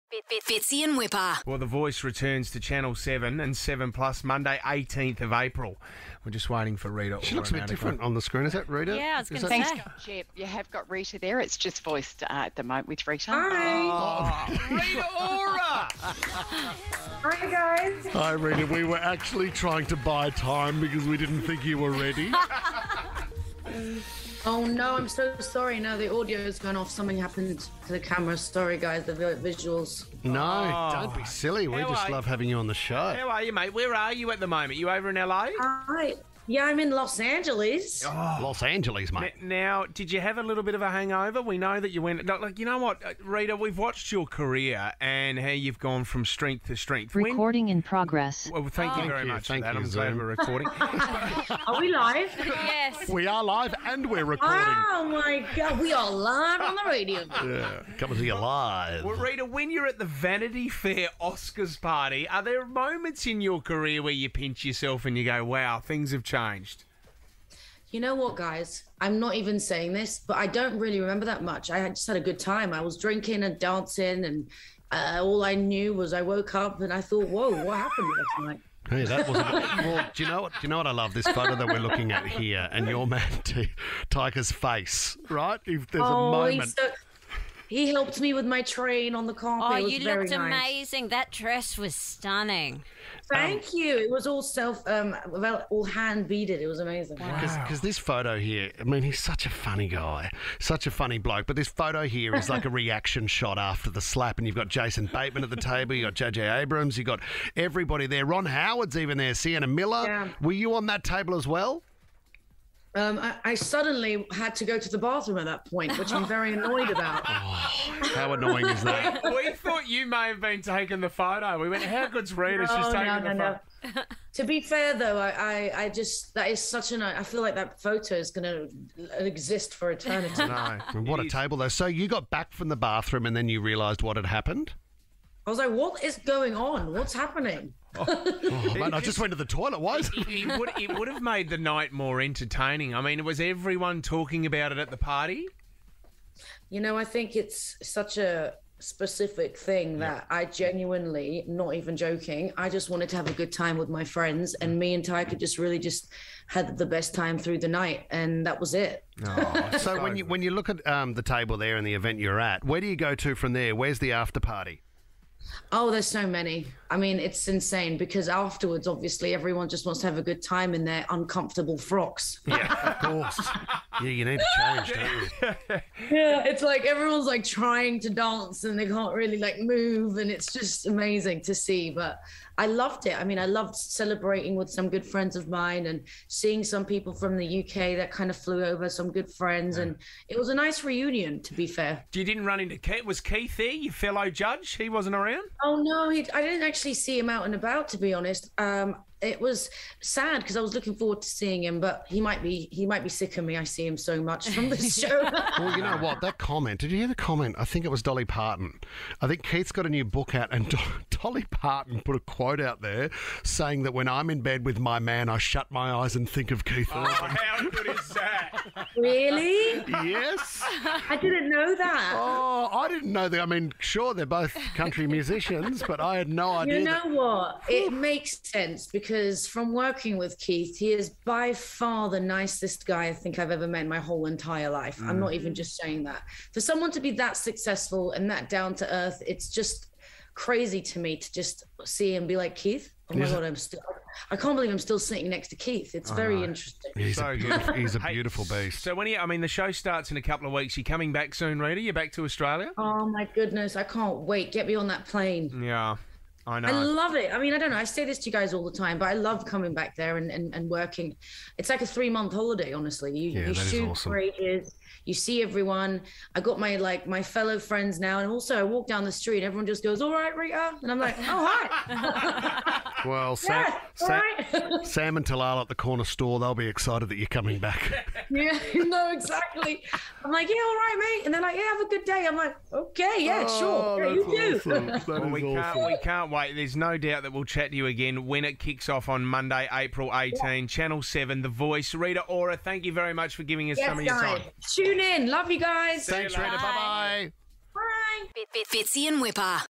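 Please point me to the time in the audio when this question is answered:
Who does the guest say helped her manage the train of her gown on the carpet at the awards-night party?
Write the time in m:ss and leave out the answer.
1:24.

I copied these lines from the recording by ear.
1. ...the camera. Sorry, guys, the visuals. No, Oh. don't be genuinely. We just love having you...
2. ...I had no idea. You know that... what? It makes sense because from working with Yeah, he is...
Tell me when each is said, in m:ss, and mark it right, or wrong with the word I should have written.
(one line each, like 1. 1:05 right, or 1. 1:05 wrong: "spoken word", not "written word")
1. 0:27 wrong: "silly", not "genuinely"
2. 3:45 wrong: "Keith", not "Yeah".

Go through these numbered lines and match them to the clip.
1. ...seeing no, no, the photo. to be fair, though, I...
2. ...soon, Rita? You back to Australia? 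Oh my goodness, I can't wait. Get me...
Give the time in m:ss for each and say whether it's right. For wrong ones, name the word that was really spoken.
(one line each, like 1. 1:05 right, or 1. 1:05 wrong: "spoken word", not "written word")
1. 2:02 wrong: "taking", not "seeing"
2. 4:11 right.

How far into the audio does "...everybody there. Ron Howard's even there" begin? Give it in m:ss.
1:47.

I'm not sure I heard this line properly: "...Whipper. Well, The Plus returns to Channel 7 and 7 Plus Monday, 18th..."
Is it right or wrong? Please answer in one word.
wrong.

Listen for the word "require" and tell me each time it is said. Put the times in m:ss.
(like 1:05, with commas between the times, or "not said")
not said.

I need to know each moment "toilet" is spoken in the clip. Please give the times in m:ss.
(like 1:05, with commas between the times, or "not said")
2:19.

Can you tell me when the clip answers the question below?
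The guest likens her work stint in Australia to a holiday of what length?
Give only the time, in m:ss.
4:21.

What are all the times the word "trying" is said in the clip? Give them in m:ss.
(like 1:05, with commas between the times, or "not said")
0:19, 2:57.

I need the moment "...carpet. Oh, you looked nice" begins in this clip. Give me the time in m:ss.
1:29.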